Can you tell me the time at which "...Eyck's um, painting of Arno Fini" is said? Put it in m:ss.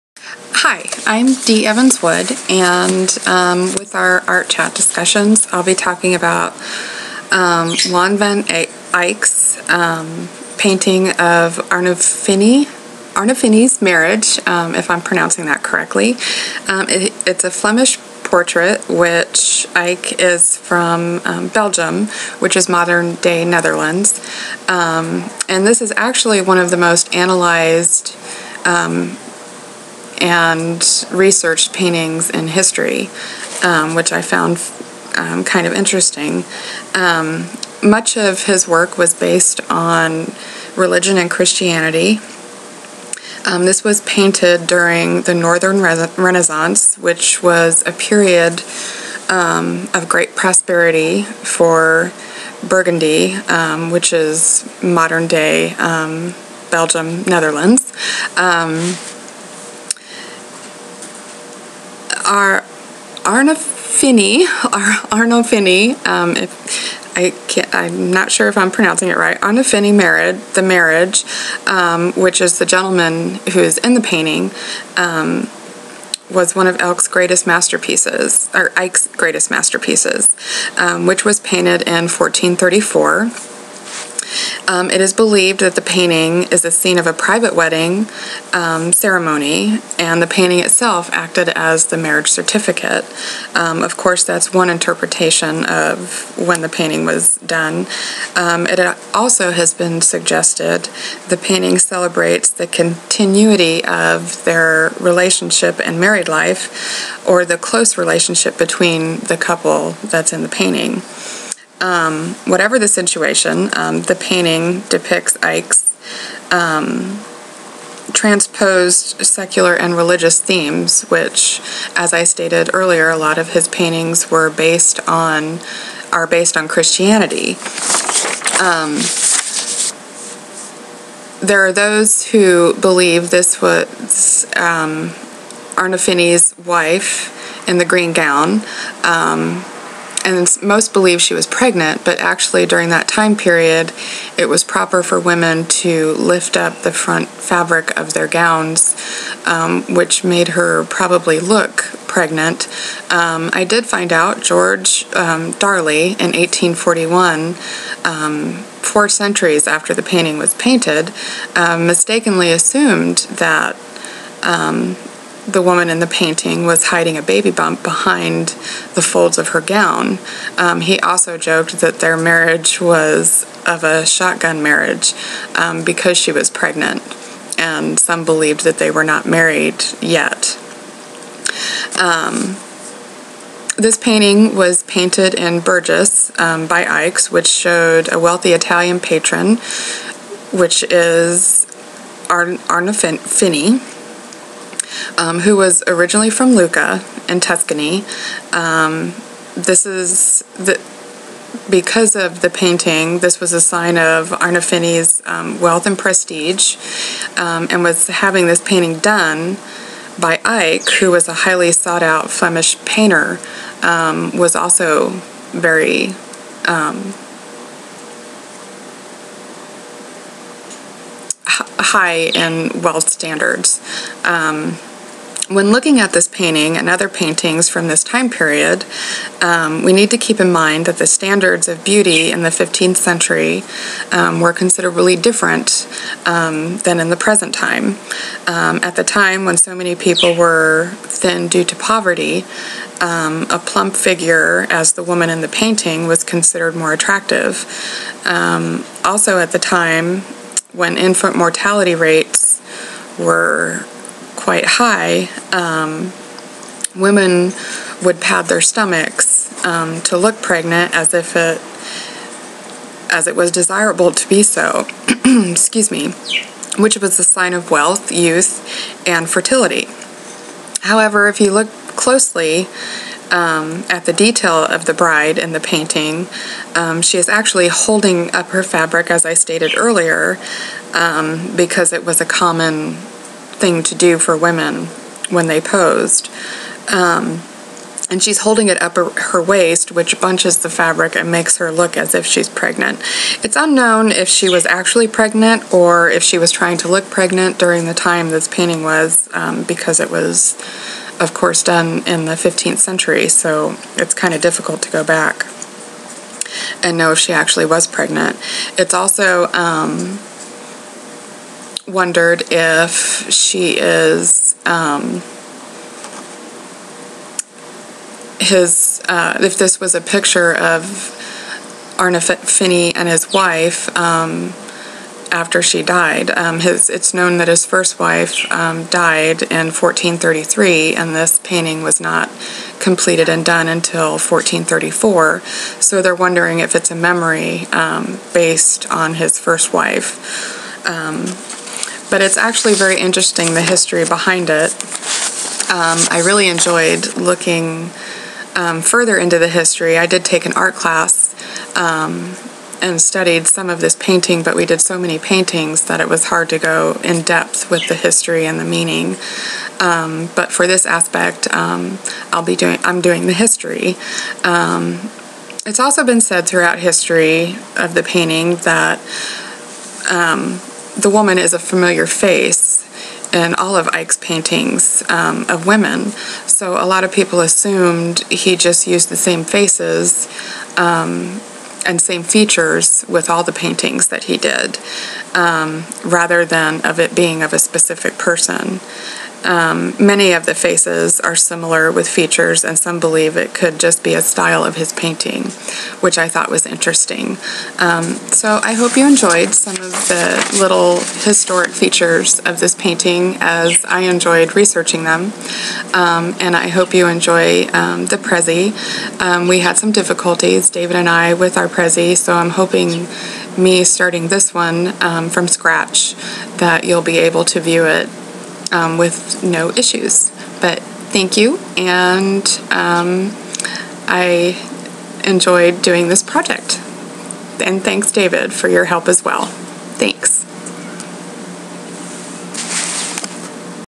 0:08.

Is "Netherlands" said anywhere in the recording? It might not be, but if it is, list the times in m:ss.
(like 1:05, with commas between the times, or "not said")
0:23, 0:57.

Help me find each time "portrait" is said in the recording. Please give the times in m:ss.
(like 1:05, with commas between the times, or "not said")
0:18.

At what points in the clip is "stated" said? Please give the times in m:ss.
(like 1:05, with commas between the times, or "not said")
2:02, 4:39.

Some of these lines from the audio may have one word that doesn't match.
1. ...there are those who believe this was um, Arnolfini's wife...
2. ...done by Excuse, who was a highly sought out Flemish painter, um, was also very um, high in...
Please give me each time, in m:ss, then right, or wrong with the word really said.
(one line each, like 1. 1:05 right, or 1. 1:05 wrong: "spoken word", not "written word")
1. 2:11 right
2. 3:28 wrong: "Eyck", not "Excuse".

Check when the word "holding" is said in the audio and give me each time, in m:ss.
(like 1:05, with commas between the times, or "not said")
4:37, 4:48.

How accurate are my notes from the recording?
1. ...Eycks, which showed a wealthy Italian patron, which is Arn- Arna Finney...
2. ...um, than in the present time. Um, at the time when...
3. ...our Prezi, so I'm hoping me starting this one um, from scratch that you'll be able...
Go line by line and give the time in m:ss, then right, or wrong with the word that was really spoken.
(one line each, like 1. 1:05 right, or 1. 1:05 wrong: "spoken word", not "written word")
1. 3:06 right
2. 3:56 right
3. 6:51 right.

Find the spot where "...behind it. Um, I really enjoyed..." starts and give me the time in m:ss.
5:44.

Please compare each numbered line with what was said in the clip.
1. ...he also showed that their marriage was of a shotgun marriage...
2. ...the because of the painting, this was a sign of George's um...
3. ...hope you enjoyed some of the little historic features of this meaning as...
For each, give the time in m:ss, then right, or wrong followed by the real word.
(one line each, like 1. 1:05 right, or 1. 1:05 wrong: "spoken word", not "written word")
1. 2:50 wrong: "joked", not "showed"
2. 3:20 wrong: "Arnolfini", not "George"
3. 6:38 wrong: "painting", not "meaning".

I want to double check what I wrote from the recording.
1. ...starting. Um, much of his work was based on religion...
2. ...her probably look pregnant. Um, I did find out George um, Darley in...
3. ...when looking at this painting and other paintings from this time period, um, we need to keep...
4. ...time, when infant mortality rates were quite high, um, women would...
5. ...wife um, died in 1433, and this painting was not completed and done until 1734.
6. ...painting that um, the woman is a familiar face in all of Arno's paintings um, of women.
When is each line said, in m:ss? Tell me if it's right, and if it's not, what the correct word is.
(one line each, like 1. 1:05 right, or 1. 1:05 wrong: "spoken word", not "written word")
1. 0:35 wrong: "interesting", not "starting"
2. 2:30 right
3. 3:45 right
4. 4:09 right
5. 5:27 wrong: "1434", not "1734"
6. 6:08 wrong: "Eyck", not "Arno".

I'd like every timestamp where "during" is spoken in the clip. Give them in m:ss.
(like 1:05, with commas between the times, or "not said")
0:44, 2:22, 4:57.